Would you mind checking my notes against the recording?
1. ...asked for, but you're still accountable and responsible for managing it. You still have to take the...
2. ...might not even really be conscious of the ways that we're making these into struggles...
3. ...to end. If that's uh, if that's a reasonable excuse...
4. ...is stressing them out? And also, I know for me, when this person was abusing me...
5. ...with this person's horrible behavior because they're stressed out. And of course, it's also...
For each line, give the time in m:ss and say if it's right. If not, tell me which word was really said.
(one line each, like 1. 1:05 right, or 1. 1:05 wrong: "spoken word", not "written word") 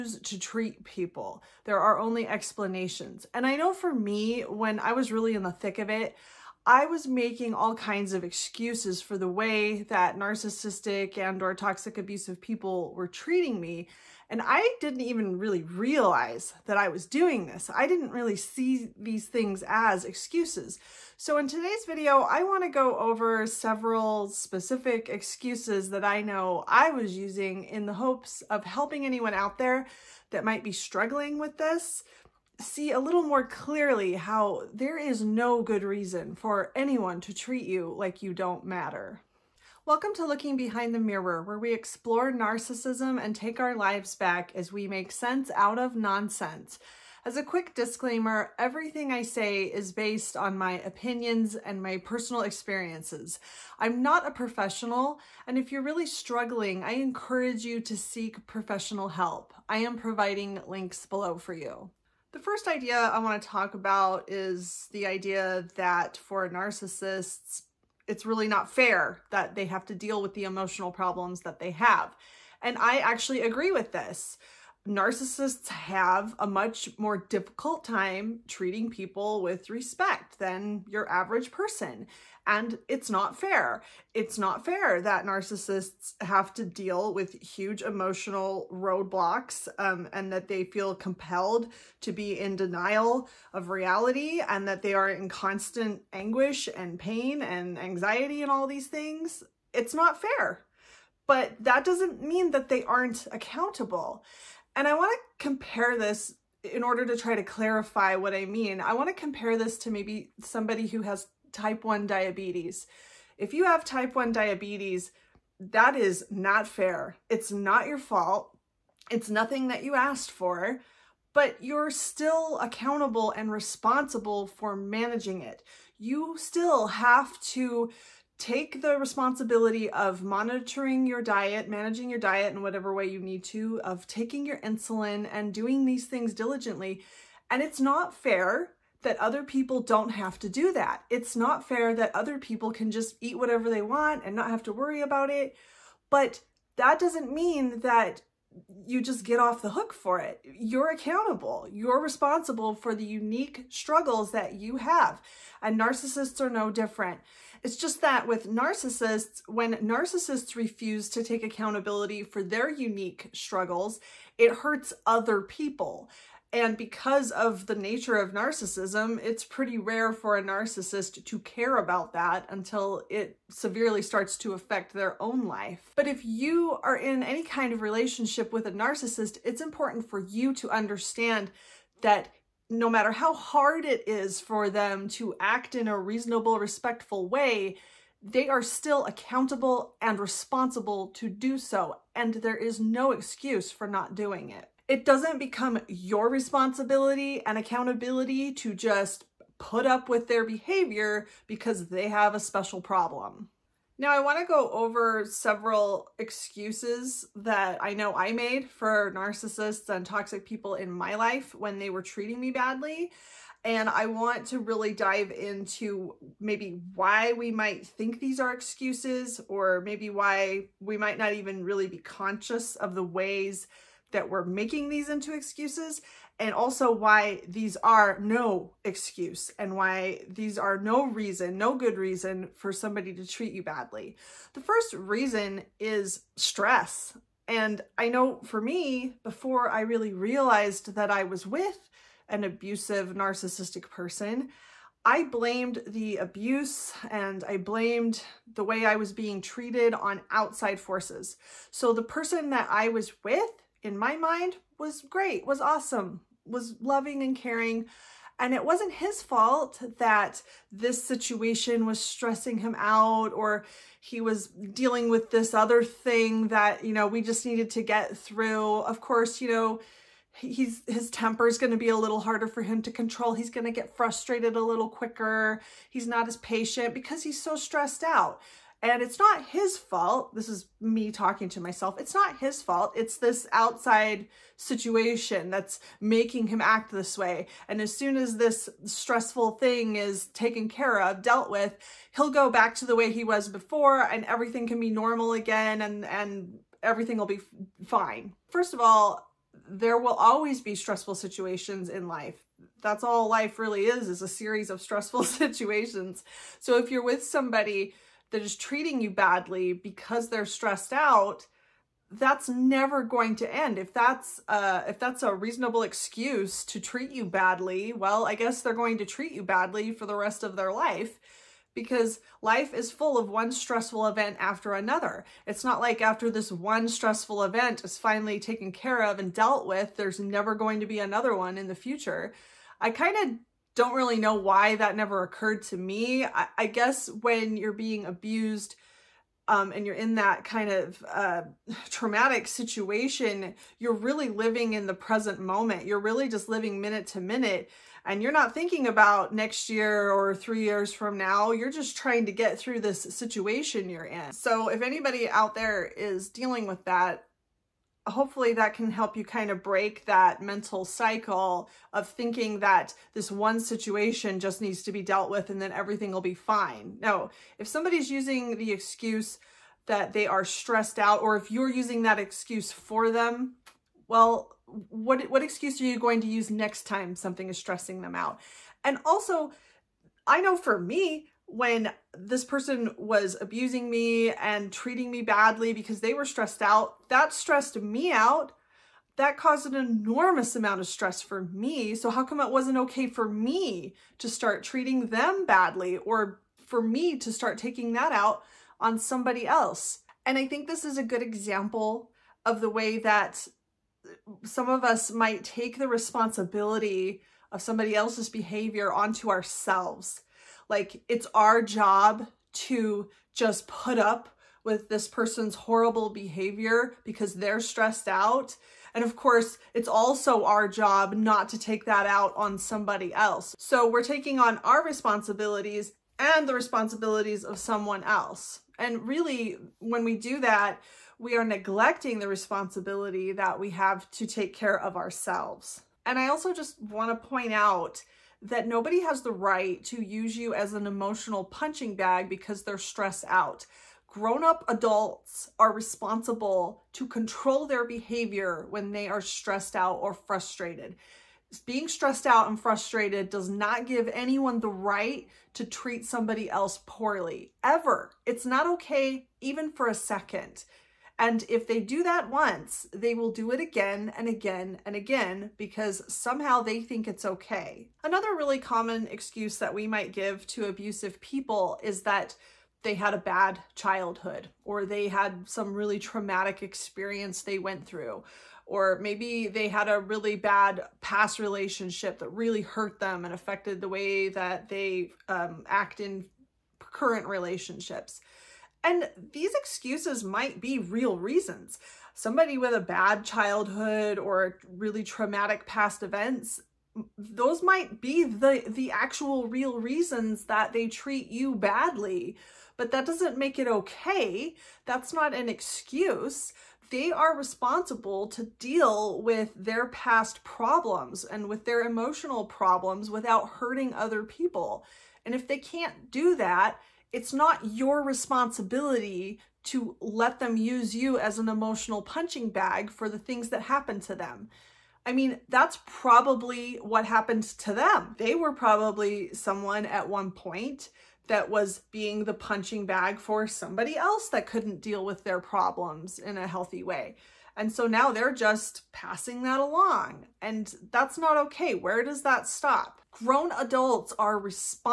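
1. 1:59 right
2. 3:40 wrong: "excuses", not "struggles"
3. 5:13 right
4. 6:17 right
5. 6:54 right.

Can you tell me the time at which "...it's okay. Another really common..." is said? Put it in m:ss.
7:47.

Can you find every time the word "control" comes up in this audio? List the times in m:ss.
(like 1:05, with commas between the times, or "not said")
4:32, 7:27.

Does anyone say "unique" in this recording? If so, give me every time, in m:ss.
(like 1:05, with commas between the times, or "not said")
2:33, 2:42.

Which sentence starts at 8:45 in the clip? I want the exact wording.
I mean, that's probably what happened to them.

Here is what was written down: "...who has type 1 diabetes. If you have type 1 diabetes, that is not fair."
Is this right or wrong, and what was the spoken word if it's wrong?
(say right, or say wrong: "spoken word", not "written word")
right.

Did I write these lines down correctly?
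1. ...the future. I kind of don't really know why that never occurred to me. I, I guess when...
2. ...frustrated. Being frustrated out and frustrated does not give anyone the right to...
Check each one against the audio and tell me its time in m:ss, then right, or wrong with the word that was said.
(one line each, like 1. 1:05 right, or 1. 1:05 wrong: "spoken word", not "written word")
1. 5:31 right
2. 7:30 wrong: "stressed", not "frustrated".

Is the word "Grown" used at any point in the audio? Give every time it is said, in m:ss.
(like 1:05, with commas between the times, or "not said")
7:24, 9:03.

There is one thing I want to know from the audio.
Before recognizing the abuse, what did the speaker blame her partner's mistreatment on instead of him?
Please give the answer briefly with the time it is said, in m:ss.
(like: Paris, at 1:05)
outside forces, at 4:10.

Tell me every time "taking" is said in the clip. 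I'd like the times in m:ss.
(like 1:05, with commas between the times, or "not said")
2:14, 6:37, 7:04.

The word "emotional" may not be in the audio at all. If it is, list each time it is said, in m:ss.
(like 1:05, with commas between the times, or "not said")
1:10, 1:27, 7:20, 8:31, 8:41.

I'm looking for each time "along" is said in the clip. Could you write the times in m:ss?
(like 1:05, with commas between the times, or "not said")
8:59.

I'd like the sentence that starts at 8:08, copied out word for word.
And these excuses might be real reasons.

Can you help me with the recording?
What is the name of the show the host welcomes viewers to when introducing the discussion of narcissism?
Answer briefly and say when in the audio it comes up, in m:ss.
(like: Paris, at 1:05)
Looking Behind the Mirror, at 0:40.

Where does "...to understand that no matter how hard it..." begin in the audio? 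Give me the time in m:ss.
3:00.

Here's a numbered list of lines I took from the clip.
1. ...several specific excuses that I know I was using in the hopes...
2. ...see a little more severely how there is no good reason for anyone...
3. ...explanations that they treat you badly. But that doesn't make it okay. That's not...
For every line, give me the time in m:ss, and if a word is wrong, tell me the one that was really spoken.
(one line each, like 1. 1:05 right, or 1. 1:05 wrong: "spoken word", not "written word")
1. 0:23 right
2. 0:32 wrong: "clearly", not "severely"
3. 8:19 wrong: "reasons", not "explanations".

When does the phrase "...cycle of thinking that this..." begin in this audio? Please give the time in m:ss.
6:00.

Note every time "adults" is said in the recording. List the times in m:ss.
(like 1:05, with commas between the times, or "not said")
7:24, 9:03.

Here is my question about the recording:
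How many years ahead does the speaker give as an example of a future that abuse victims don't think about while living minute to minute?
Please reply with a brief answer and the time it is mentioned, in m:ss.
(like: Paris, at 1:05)
3, at 5:50.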